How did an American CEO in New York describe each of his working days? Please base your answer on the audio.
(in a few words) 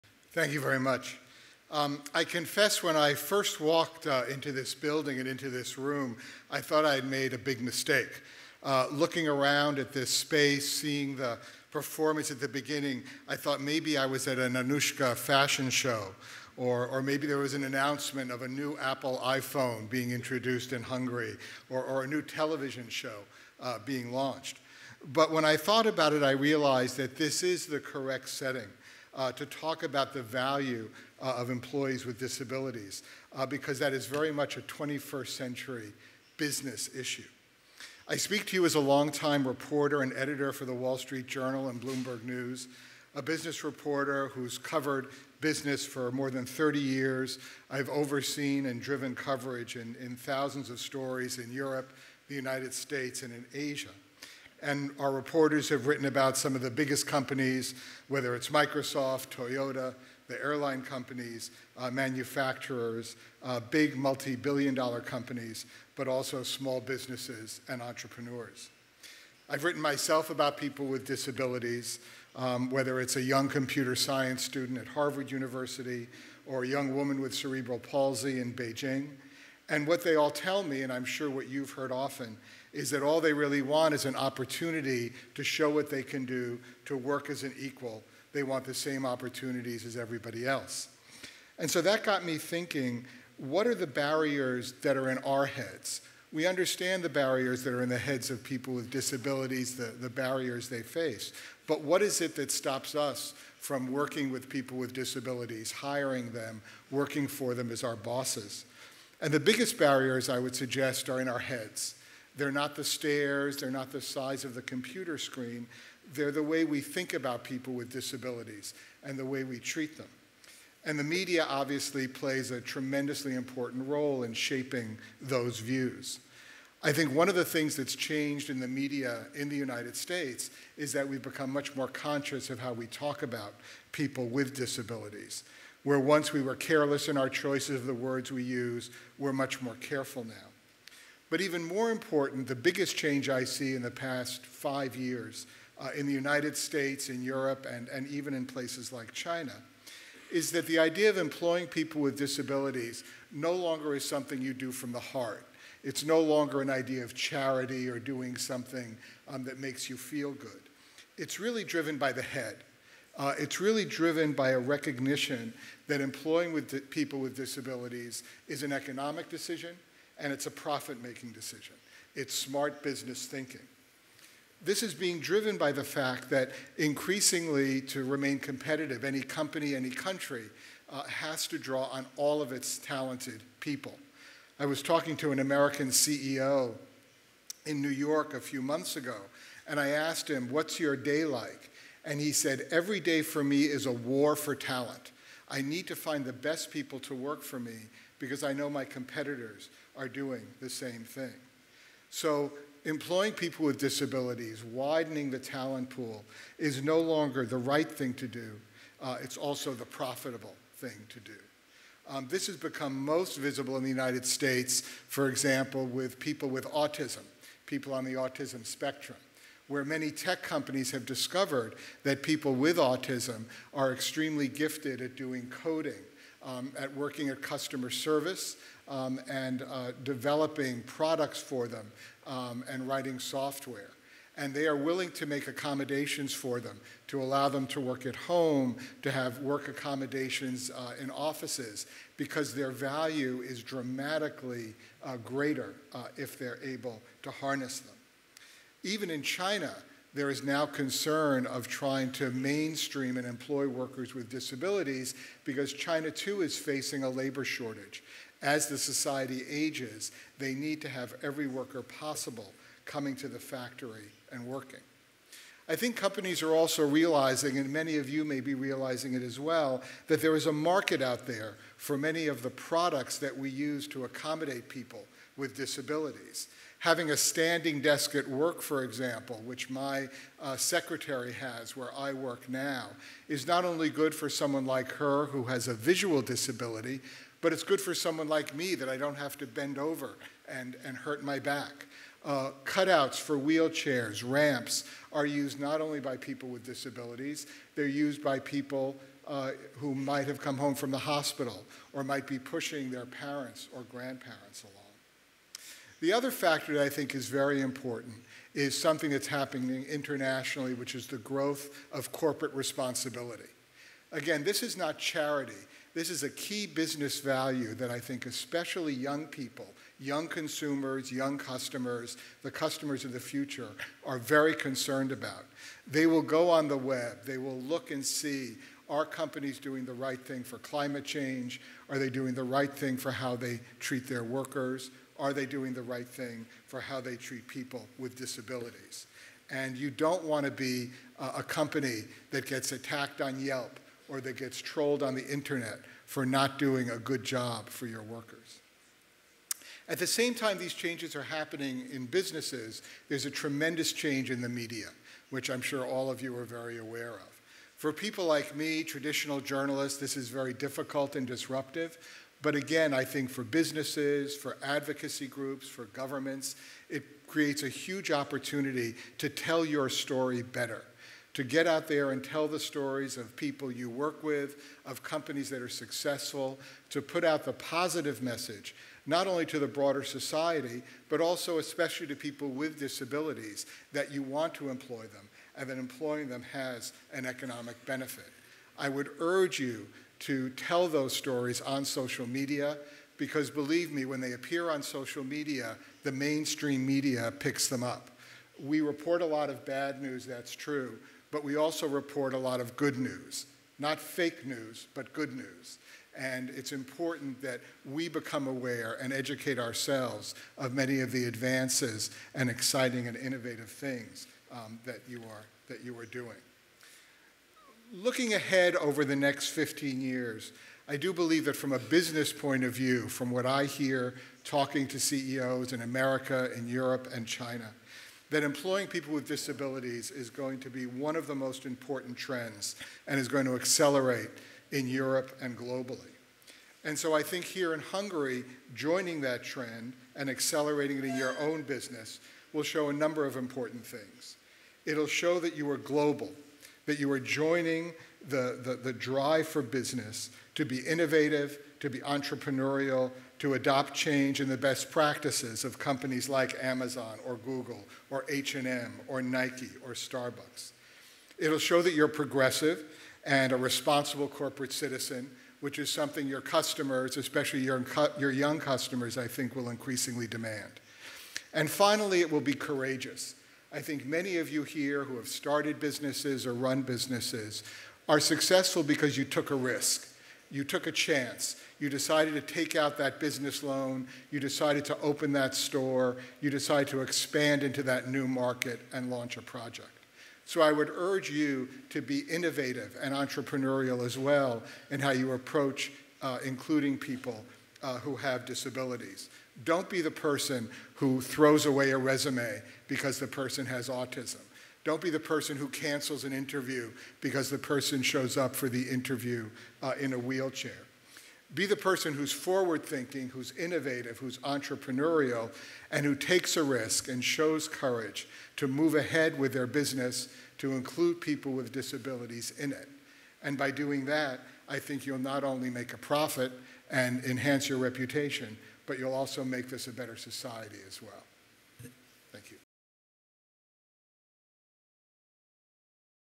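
a war for talent.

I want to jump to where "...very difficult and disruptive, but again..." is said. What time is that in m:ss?
6:00.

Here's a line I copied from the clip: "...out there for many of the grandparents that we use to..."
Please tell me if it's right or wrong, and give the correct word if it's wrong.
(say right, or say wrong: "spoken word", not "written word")
wrong: "products", not "grandparents".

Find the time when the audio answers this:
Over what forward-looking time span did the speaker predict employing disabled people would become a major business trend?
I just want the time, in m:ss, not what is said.
6:59.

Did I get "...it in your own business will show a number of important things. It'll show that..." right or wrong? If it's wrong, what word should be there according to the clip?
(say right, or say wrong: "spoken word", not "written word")
right.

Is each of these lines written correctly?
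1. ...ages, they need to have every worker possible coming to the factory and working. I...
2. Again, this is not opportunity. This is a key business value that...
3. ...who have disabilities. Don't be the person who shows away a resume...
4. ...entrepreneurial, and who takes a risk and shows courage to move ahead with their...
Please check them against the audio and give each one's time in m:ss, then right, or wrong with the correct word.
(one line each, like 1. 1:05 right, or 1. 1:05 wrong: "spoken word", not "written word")
1. 4:19 right
2. 5:14 wrong: "charity", not "opportunity"
3. 8:17 wrong: "throws", not "shows"
4. 8:34 right.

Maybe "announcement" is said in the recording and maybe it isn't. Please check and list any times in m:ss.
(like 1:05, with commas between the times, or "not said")
0:17.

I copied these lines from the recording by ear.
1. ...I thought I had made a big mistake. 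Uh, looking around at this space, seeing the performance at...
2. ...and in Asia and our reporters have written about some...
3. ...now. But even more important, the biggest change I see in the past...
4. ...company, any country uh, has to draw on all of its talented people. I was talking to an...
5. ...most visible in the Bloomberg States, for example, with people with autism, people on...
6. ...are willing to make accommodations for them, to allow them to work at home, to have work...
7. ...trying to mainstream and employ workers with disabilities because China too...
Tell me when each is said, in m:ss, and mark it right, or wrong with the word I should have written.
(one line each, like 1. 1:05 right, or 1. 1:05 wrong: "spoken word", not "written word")
1. 0:06 right
2. 0:53 right
3. 2:20 right
4. 2:59 right
5. 3:33 wrong: "United", not "Bloomberg"
6. 3:54 right
7. 4:11 right.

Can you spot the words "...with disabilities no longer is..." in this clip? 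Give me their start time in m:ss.
2:31.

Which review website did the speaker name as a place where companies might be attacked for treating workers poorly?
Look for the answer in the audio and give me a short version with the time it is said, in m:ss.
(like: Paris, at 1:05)
Yelp, at 5:43.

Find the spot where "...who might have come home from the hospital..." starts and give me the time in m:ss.
4:59.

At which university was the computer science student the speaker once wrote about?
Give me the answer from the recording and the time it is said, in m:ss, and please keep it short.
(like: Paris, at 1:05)
Harvard University, at 1:14.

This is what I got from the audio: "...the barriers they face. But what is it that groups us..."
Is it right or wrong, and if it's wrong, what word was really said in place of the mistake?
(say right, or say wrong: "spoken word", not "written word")
wrong: "stops", not "groups".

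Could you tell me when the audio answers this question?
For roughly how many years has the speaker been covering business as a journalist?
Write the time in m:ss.
0:46.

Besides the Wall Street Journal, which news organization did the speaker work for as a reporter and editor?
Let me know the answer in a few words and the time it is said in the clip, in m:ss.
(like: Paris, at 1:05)
Bloomberg News, at 0:41.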